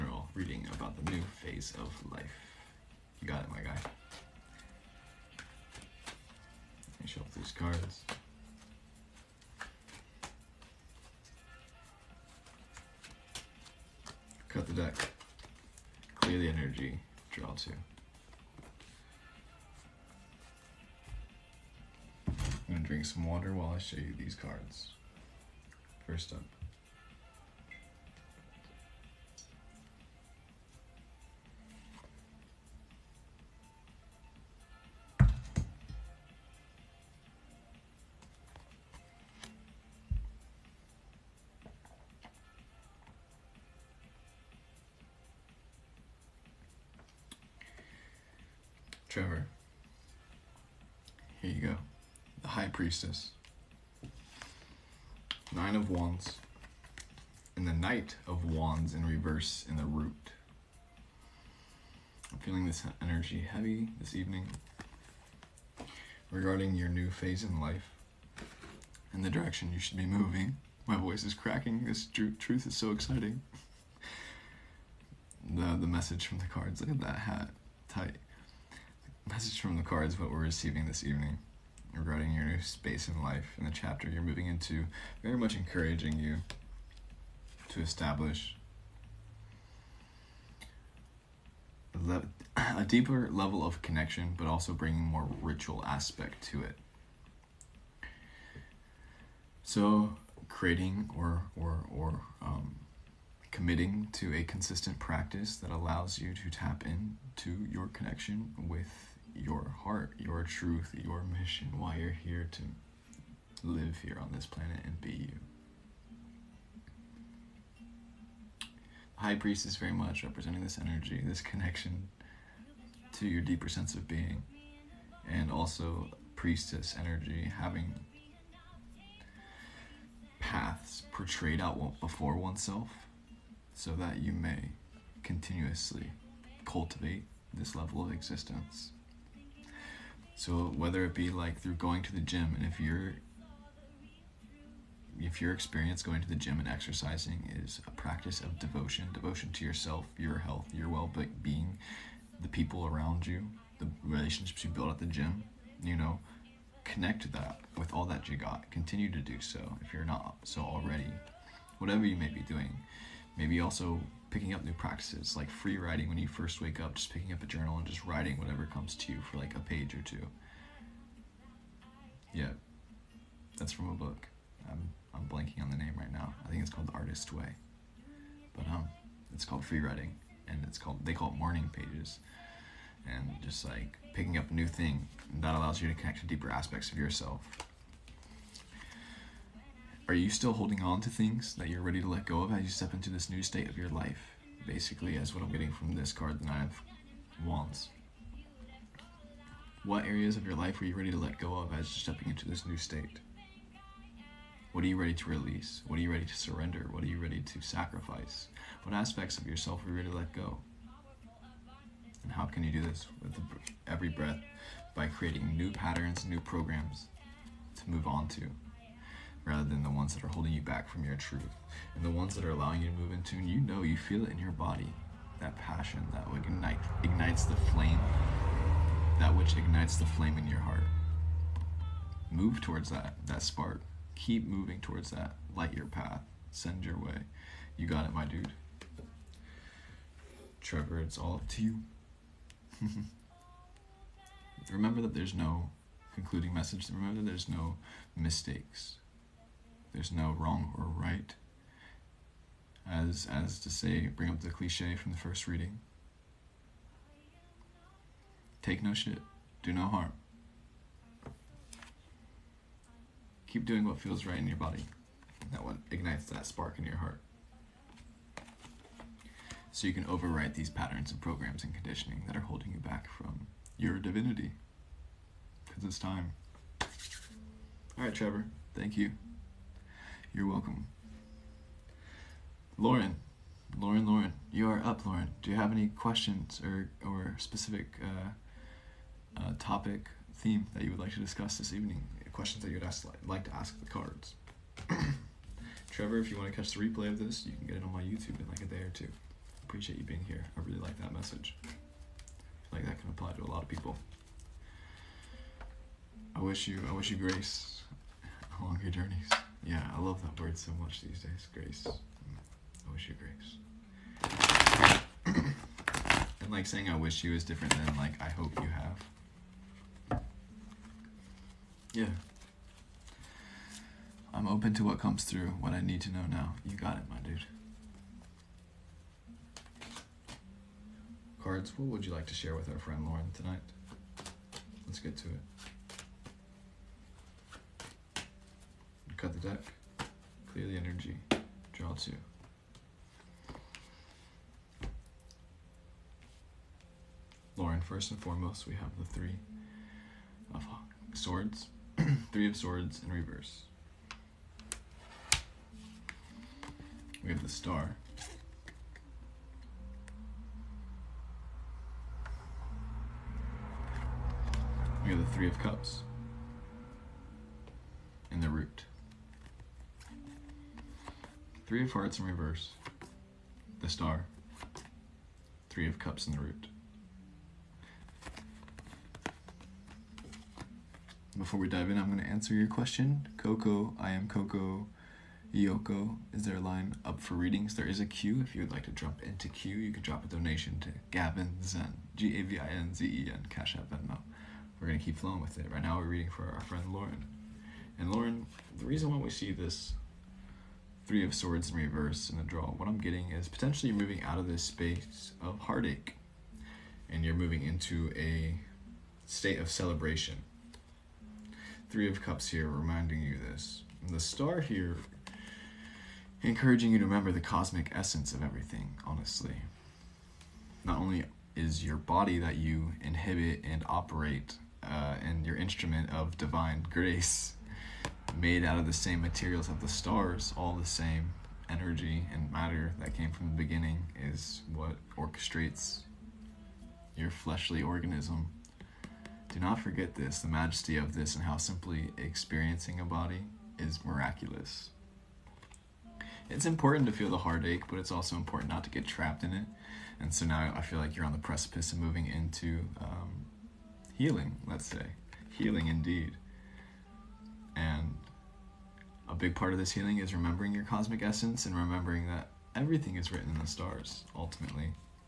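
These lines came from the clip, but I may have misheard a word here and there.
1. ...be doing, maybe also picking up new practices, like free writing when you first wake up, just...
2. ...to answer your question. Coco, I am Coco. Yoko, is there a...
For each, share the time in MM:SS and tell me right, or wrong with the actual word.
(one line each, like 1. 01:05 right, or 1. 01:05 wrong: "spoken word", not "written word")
1. 02:42 right
2. 06:22 right.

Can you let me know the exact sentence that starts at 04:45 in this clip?
Do you have any questions or, or specific uh, uh, topic, theme that you would like to discuss this evening?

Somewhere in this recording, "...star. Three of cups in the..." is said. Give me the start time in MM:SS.
06:13.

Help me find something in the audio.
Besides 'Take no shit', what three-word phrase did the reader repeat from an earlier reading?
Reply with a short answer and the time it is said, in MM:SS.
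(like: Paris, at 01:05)
Do no harm, at 04:19.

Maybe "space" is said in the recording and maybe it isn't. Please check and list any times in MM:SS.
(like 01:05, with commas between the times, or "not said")
01:22, 06:44.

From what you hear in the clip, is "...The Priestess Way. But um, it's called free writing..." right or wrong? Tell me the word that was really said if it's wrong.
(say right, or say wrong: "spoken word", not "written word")
wrong: "Artist", not "Priestess".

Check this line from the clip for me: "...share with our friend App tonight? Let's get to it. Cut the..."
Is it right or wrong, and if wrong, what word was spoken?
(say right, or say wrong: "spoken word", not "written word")
wrong: "Lauren", not "App".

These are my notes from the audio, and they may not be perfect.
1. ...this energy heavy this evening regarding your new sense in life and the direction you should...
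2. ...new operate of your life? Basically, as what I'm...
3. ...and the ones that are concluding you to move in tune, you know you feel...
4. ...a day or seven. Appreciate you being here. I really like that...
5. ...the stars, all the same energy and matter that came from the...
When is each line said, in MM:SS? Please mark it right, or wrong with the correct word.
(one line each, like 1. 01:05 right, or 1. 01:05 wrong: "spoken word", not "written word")
1. 01:02 wrong: "phase", not "sense"
2. 03:13 wrong: "state", not "operate"
3. 03:41 wrong: "allowing", not "concluding"
4. 04:58 wrong: "two", not "seven"
5. 07:09 right.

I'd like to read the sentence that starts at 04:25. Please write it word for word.
That one ignites that spark in your heart.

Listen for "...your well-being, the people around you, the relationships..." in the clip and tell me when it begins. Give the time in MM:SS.
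02:30.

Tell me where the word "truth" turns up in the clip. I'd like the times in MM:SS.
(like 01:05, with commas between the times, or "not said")
01:12, 01:50, 03:41.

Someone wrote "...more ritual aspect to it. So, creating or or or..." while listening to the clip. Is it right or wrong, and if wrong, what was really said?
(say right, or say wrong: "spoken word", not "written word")
right.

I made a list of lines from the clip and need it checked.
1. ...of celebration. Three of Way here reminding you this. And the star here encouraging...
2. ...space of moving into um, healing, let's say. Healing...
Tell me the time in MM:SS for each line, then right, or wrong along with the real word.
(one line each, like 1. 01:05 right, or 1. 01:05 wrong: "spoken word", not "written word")
1. 06:49 wrong: "Cups", not "Way"
2. 07:31 wrong: "precipice", not "space".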